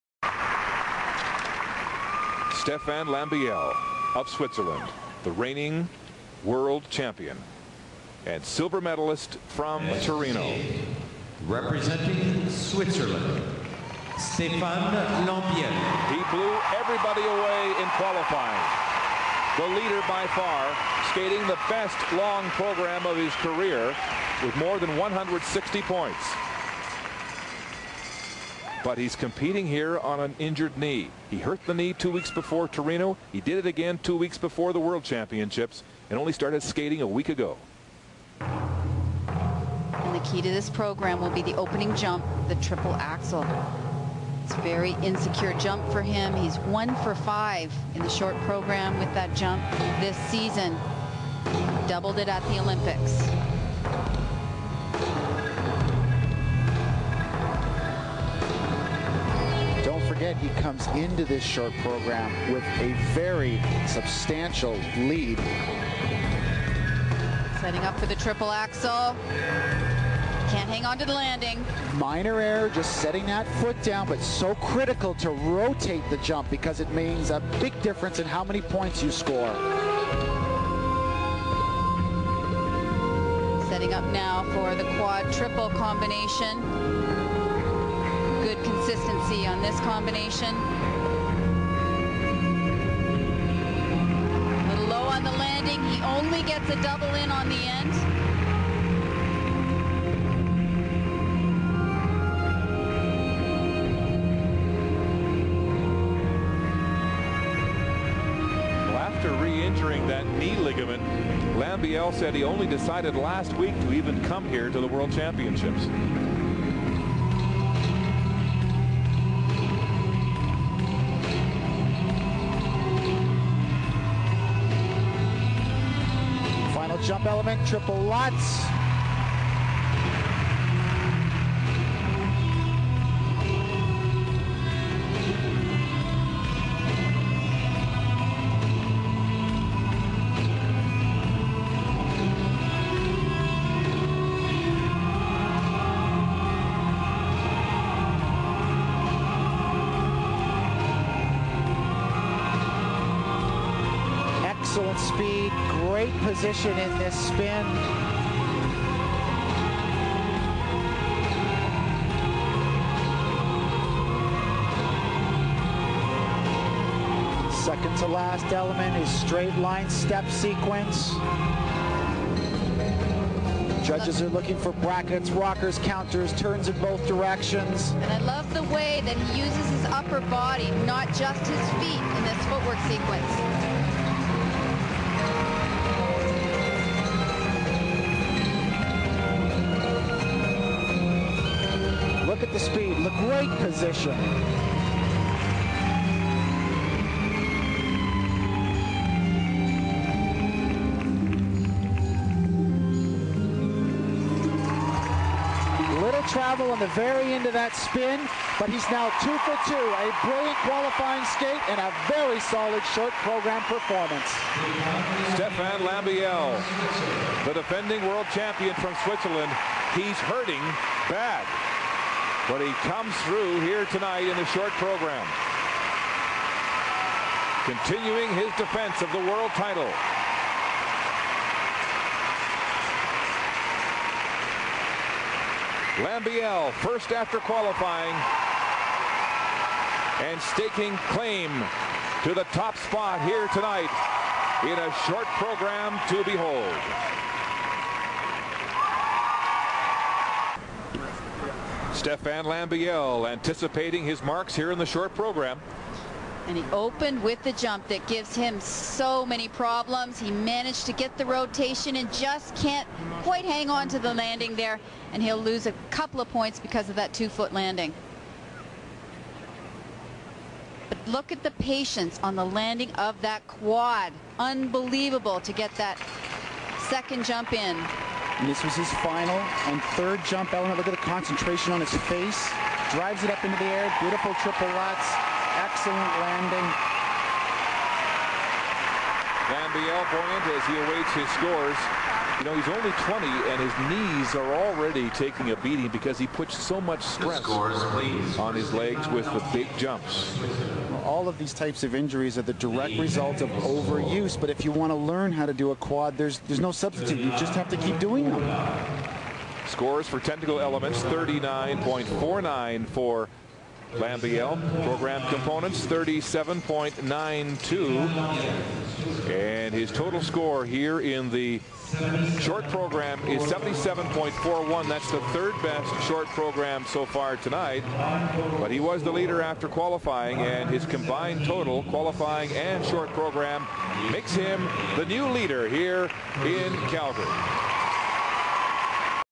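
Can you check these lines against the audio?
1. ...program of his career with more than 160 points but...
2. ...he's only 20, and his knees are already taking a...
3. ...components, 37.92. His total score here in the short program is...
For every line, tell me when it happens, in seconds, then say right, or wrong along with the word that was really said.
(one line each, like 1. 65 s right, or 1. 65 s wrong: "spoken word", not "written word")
1. 22 s right
2. 292 s right
3. 315 s right.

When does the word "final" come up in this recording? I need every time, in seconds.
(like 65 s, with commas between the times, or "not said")
279 s.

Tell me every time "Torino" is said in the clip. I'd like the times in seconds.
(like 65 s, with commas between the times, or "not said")
10 s, 32 s.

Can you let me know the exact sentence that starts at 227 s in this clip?
Continuing his defense of the world title.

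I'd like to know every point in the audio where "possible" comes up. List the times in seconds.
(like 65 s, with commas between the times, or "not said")
not said.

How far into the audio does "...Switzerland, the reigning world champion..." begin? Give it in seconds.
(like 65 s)
4 s.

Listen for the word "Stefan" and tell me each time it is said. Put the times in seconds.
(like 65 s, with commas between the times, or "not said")
2 s, 14 s, 215 s, 251 s.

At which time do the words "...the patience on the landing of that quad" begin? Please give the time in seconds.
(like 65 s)
271 s.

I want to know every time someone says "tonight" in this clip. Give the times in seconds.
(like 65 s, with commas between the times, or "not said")
223 s, 243 s, 327 s.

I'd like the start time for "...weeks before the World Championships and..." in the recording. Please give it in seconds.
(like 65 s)
34 s.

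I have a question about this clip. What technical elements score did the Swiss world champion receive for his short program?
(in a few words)
39.49.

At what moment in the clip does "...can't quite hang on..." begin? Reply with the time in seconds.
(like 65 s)
262 s.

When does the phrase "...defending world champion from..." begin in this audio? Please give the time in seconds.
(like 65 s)
217 s.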